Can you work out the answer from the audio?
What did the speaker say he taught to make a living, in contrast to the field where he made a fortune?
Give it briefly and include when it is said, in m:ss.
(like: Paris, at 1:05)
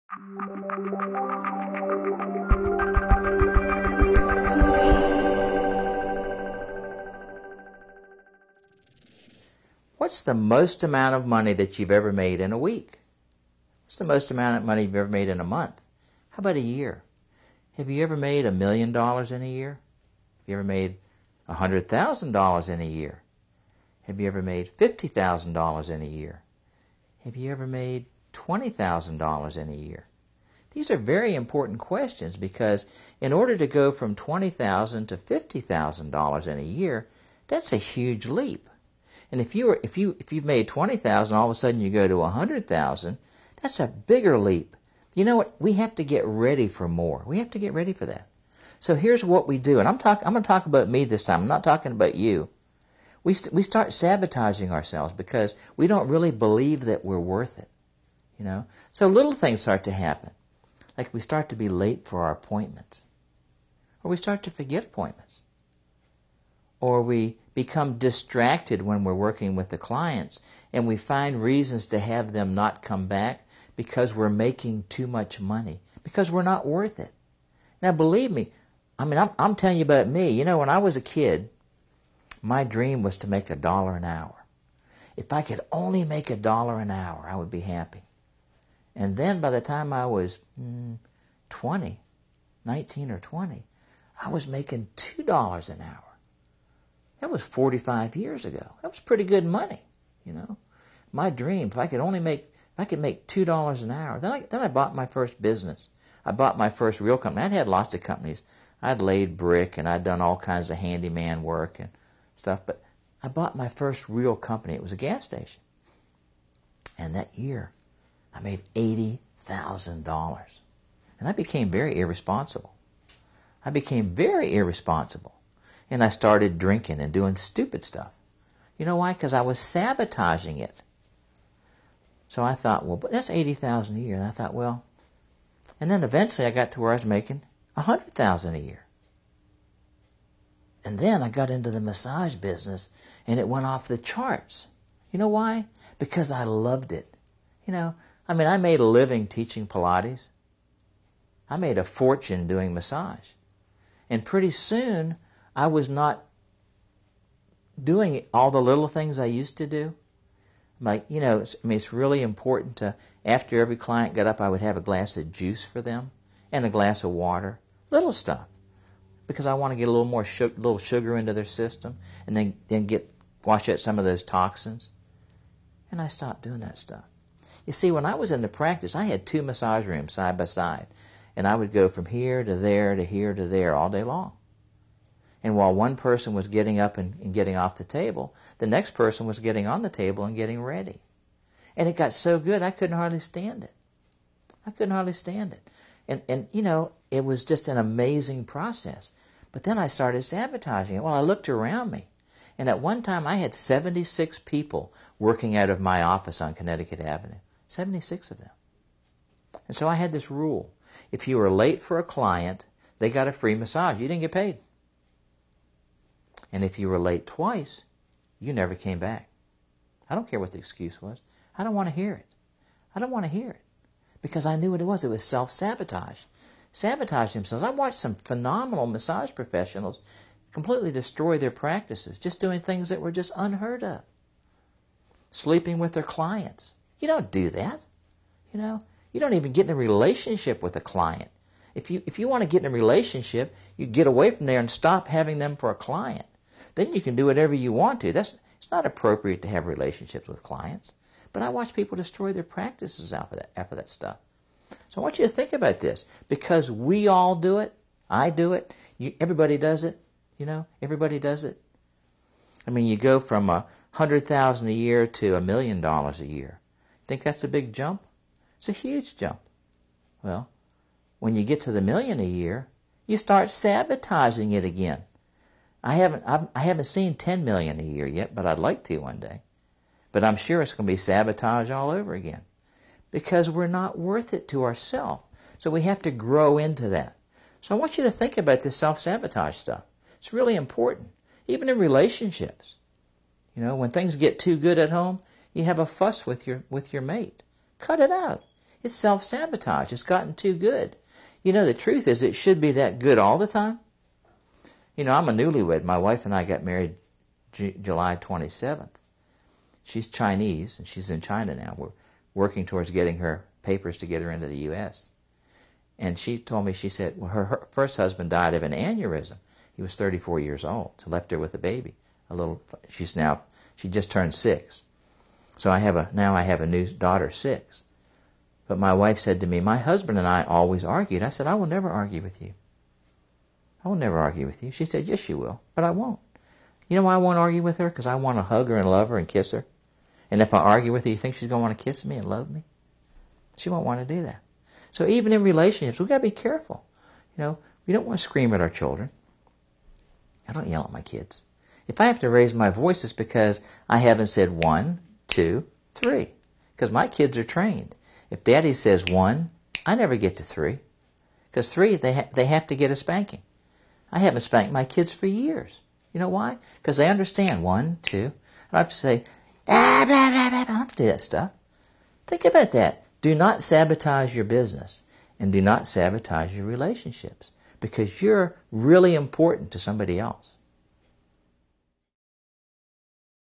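Pilates, at 2:29.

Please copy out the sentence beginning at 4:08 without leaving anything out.
That's it's not appropriate to have relationships with clients.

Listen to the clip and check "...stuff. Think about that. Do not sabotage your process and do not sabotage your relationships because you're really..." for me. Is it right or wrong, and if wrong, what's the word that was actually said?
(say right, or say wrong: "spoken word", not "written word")
wrong: "business", not "process".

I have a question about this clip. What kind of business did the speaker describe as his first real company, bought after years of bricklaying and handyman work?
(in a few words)
Gas station.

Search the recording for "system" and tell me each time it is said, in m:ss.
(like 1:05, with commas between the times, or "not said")
2:51.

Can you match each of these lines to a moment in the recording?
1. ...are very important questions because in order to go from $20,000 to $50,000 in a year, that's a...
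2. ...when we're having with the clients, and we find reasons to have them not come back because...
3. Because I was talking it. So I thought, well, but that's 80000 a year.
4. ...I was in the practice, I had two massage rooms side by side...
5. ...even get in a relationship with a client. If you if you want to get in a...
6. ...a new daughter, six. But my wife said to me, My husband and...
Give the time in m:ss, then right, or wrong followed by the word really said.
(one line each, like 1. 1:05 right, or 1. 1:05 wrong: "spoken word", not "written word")
1. 0:30 right
2. 1:08 wrong: "working", not "having"
3. 2:09 wrong: "sabotaging", not "talking"
4. 2:58 right
5. 3:59 right
6. 5:26 right.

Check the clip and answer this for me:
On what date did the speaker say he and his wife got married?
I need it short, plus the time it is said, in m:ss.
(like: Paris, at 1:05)
July 27, at 5:07.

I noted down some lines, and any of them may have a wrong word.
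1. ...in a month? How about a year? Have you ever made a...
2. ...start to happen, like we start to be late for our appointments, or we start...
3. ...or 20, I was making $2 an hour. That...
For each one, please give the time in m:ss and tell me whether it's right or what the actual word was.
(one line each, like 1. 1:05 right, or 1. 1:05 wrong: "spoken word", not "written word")
1. 0:15 right
2. 0:59 right
3. 1:33 right.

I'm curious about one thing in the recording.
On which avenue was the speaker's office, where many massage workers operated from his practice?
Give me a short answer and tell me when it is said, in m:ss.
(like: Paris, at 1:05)
Connecticut Avenue, at 3:26.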